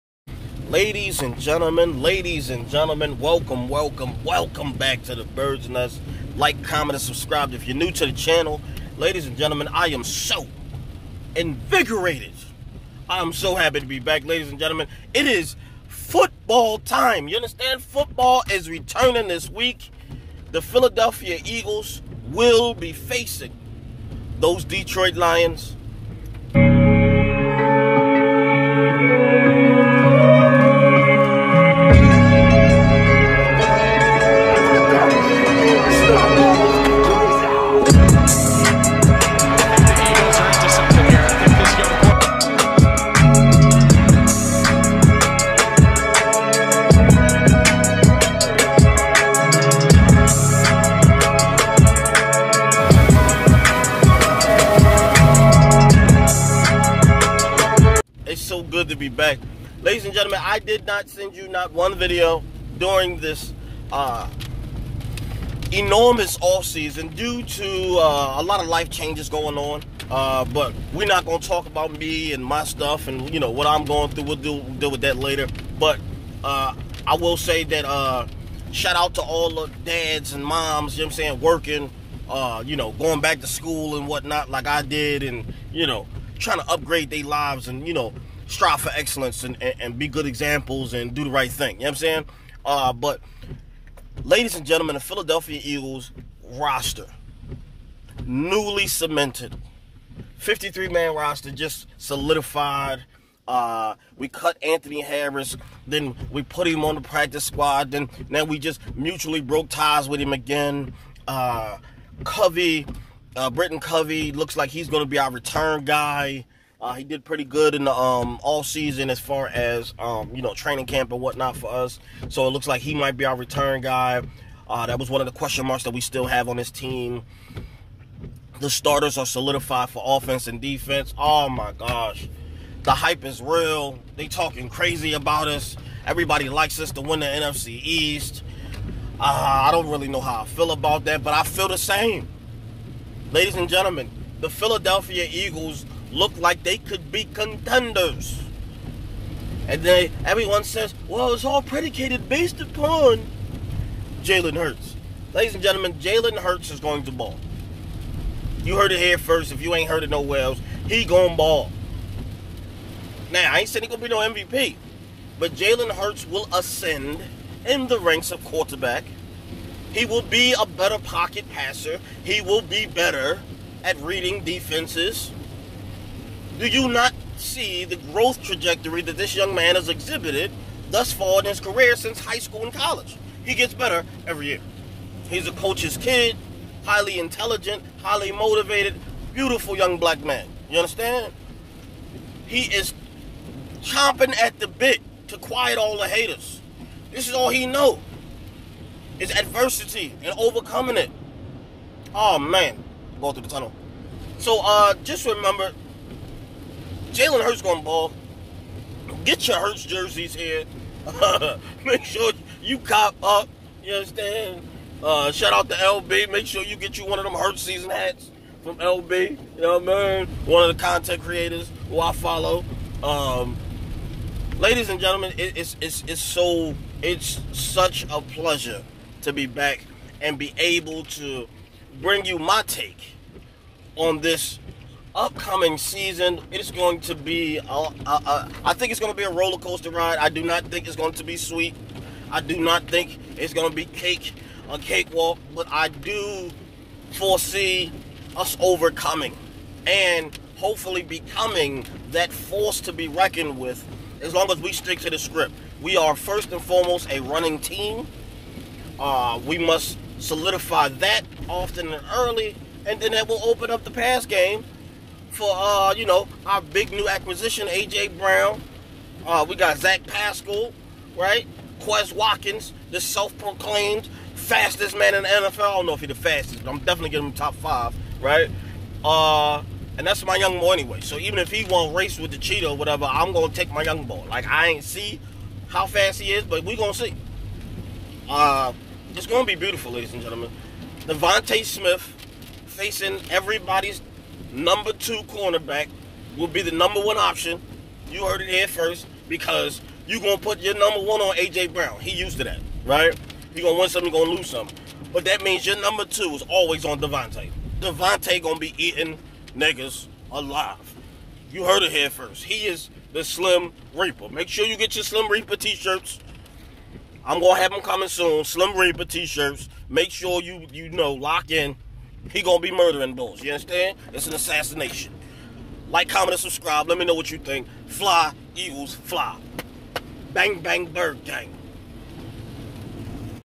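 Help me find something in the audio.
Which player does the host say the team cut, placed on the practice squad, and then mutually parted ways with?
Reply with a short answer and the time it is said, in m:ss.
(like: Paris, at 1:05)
Anthony Harris, at 1:44.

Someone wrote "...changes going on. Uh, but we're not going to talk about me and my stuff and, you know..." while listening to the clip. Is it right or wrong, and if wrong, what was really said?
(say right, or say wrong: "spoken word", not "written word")
right.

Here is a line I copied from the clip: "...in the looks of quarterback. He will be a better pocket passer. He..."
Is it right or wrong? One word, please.
wrong.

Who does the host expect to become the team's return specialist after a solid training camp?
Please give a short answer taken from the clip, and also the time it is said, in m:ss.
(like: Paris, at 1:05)
Britton Covey, at 1:53.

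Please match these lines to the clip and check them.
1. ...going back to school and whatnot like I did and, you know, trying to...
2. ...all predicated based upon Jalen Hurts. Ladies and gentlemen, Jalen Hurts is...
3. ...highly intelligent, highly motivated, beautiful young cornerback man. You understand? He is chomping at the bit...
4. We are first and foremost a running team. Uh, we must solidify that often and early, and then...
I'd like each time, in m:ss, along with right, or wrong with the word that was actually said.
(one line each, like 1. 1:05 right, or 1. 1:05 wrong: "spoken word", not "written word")
1. 1:22 right
2. 2:31 right
3. 3:06 wrong: "black", not "cornerback"
4. 4:15 right.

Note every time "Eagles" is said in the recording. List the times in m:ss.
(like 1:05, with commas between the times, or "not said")
0:21, 1:35, 2:25, 5:28.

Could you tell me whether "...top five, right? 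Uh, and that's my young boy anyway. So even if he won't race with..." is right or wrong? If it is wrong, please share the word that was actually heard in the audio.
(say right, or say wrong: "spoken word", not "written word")
right.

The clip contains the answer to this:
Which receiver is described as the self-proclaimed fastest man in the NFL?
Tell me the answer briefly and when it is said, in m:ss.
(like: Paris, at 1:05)
Quez Watkins, at 4:31.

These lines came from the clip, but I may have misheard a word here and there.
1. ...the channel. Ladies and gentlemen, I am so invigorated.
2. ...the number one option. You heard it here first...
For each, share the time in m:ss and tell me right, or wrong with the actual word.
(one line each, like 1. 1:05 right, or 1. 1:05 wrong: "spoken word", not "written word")
1. 0:08 right
2. 4:56 right.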